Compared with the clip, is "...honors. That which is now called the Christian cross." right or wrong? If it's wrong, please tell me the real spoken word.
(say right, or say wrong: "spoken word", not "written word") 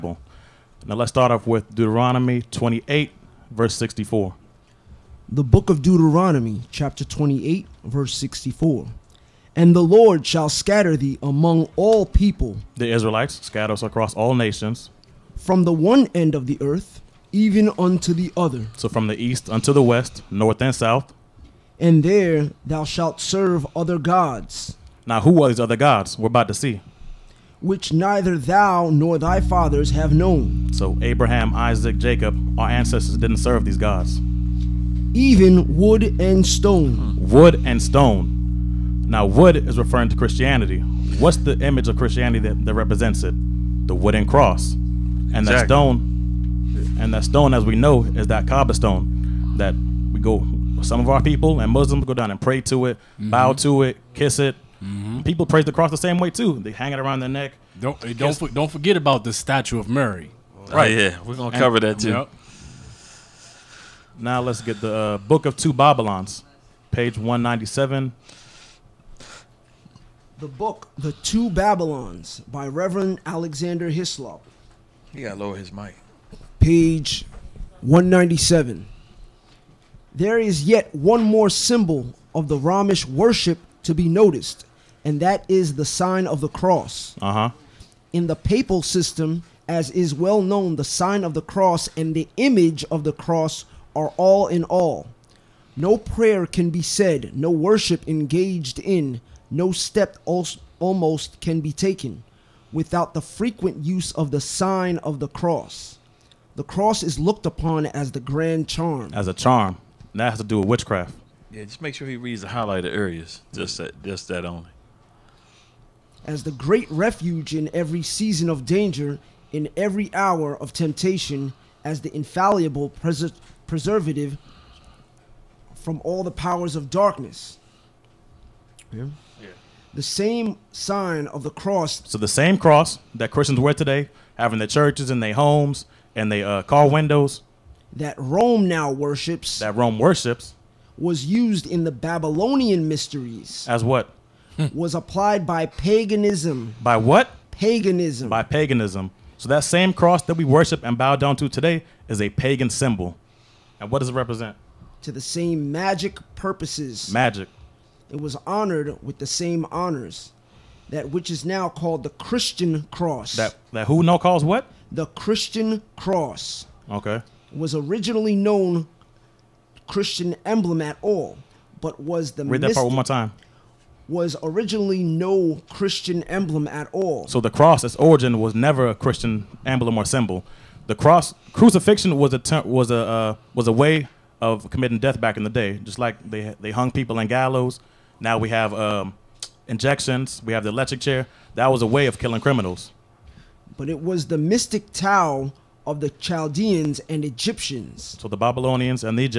right.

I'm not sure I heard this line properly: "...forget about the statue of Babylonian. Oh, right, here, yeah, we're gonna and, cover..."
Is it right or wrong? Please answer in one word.
wrong.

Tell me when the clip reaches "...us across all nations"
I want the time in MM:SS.
00:13.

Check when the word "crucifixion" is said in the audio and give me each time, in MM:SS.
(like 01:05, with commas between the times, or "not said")
03:01.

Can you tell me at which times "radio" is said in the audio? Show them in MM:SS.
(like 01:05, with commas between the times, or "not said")
not said.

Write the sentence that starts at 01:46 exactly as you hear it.
The cross is looked upon as the grand charm.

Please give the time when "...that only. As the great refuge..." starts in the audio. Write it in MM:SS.
01:54.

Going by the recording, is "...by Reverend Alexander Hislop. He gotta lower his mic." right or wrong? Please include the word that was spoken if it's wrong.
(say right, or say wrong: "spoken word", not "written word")
right.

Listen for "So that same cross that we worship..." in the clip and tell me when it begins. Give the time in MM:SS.
02:29.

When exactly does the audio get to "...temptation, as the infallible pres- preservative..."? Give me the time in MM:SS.
02:00.